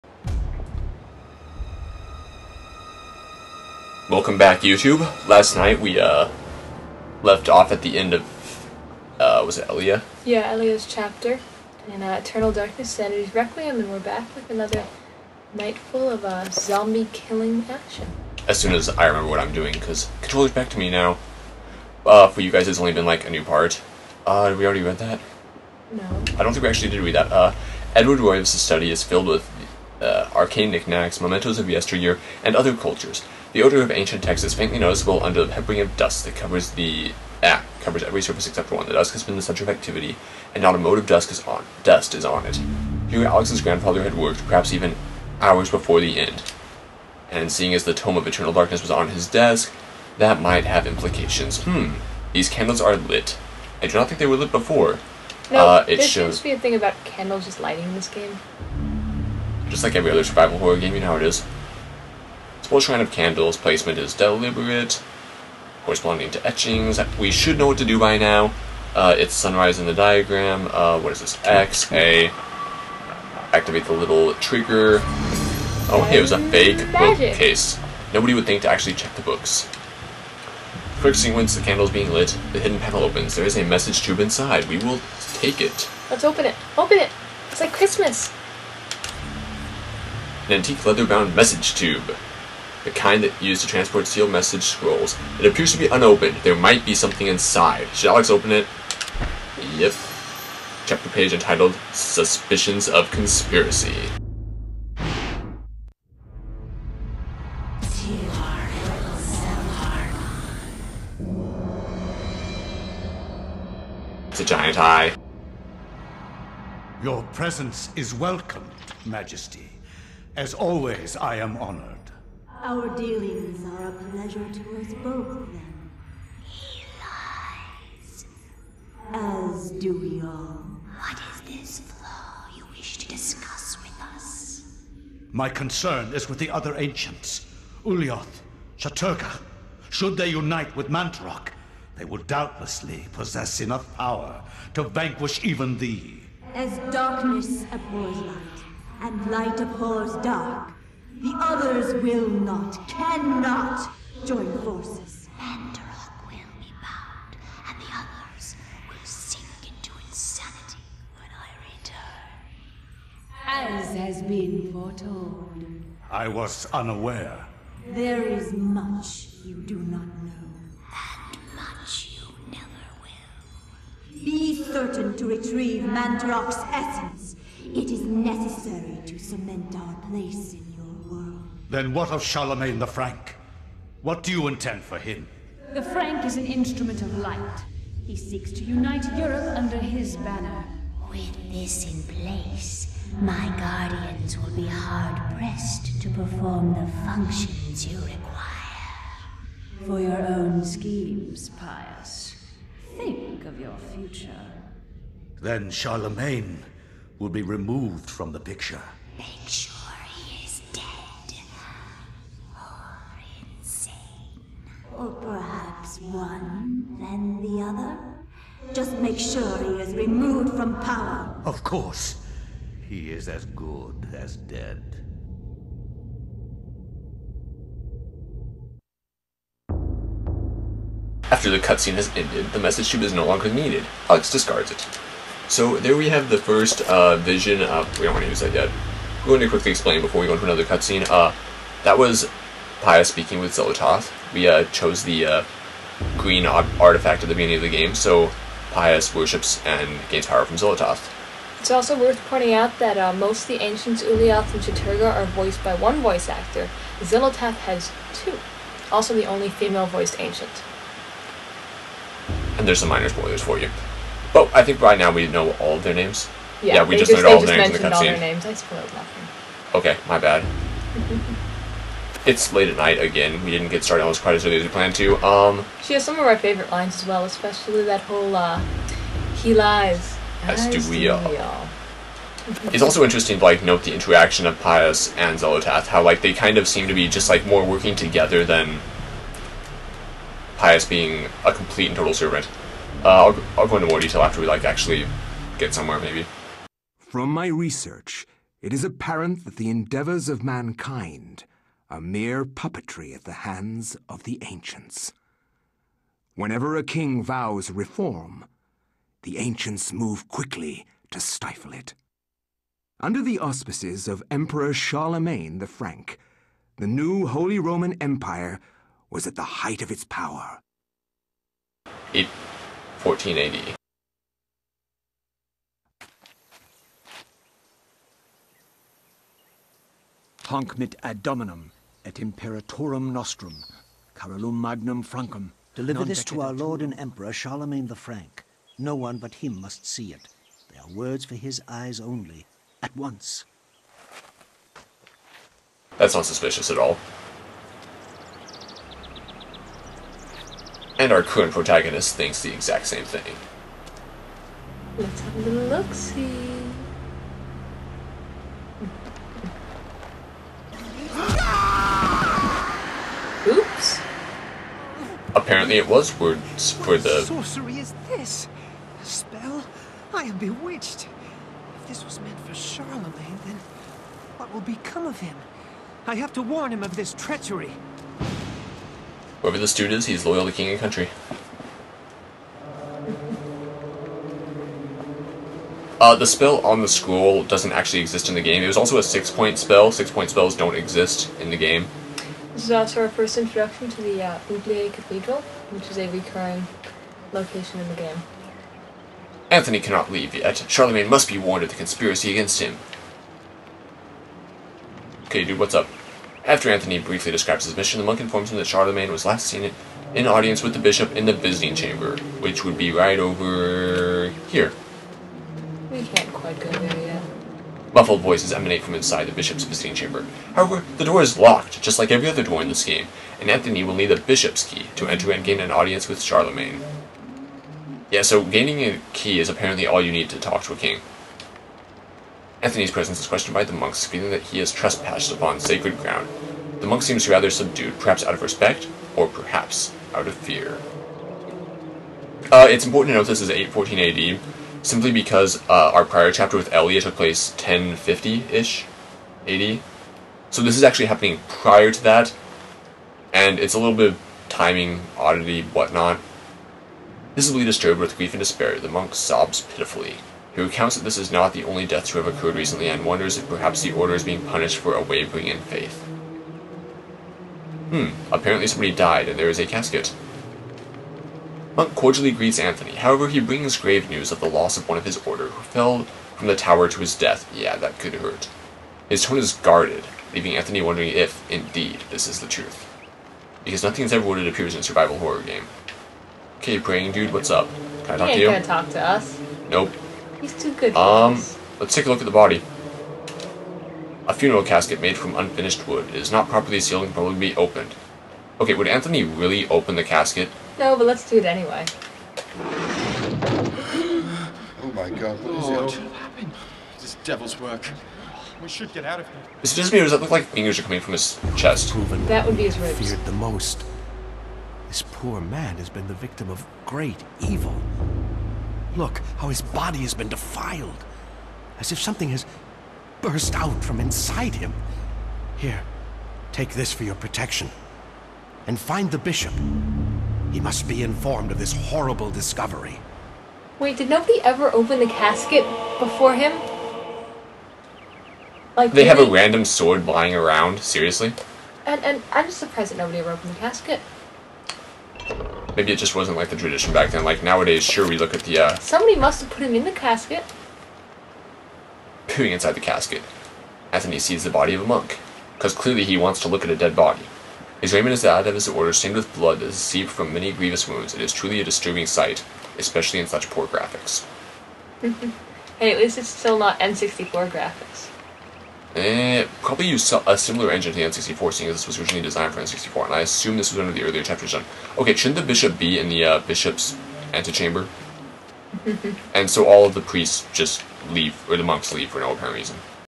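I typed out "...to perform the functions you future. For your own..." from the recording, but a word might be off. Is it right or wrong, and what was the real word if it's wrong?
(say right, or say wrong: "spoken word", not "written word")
wrong: "require", not "future".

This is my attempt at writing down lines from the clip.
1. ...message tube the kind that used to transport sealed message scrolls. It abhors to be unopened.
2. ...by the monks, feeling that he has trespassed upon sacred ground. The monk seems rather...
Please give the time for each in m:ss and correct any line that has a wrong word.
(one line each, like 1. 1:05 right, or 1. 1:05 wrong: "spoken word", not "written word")
1. 1:31 wrong: "appears", not "abhors"
2. 7:13 right.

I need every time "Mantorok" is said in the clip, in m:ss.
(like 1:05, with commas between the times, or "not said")
2:20, 2:35, 2:55.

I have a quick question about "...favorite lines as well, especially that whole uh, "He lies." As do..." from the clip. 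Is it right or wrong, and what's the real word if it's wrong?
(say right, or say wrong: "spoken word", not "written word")
right.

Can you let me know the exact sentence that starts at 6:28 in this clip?
It was also a six-point spell.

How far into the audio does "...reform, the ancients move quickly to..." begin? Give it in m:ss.
5:07.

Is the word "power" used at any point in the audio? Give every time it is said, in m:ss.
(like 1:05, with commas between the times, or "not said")
2:23, 3:40, 4:10, 5:20.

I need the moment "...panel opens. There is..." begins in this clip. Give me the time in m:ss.
1:22.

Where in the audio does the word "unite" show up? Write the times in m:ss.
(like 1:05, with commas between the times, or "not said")
2:20, 3:08.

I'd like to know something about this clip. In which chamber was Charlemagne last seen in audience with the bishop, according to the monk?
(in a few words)
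Byzantine chamber.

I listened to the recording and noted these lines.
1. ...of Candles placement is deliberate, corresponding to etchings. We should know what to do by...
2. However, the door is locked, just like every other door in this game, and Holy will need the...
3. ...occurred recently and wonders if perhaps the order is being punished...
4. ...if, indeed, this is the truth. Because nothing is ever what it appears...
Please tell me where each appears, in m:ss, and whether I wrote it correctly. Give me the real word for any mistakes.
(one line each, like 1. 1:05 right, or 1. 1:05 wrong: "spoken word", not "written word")
1. 1:03 right
2. 7:00 wrong: "Anthony", not "Holy"
3. 7:42 right
4. 8:01 right.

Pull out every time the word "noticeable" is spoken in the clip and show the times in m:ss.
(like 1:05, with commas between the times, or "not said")
0:34.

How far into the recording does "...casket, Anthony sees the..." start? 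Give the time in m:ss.
9:12.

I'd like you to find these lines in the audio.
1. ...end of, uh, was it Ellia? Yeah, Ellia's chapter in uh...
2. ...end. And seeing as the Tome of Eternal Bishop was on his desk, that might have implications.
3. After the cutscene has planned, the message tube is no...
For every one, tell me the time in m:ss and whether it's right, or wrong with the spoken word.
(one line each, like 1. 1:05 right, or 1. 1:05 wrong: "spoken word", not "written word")
1. 0:07 right
2. 0:46 wrong: "Darkness", not "Bishop"
3. 3:51 wrong: "ended", not "planned".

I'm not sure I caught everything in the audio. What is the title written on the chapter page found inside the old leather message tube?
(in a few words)
Suspicions of Conspiracy.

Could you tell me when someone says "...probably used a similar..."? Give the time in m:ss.
9:29.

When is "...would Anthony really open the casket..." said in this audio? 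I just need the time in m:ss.
8:18.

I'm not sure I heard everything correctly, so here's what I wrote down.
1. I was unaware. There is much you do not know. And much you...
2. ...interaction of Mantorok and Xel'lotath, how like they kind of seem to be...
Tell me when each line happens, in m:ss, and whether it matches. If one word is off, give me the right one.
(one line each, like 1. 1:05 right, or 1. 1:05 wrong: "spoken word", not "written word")
1. 2:46 right
2. 4:43 wrong: "Pius", not "Mantorok".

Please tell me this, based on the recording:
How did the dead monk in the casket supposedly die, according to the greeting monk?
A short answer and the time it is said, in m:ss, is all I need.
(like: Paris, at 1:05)
Fell from the tower, at 7:55.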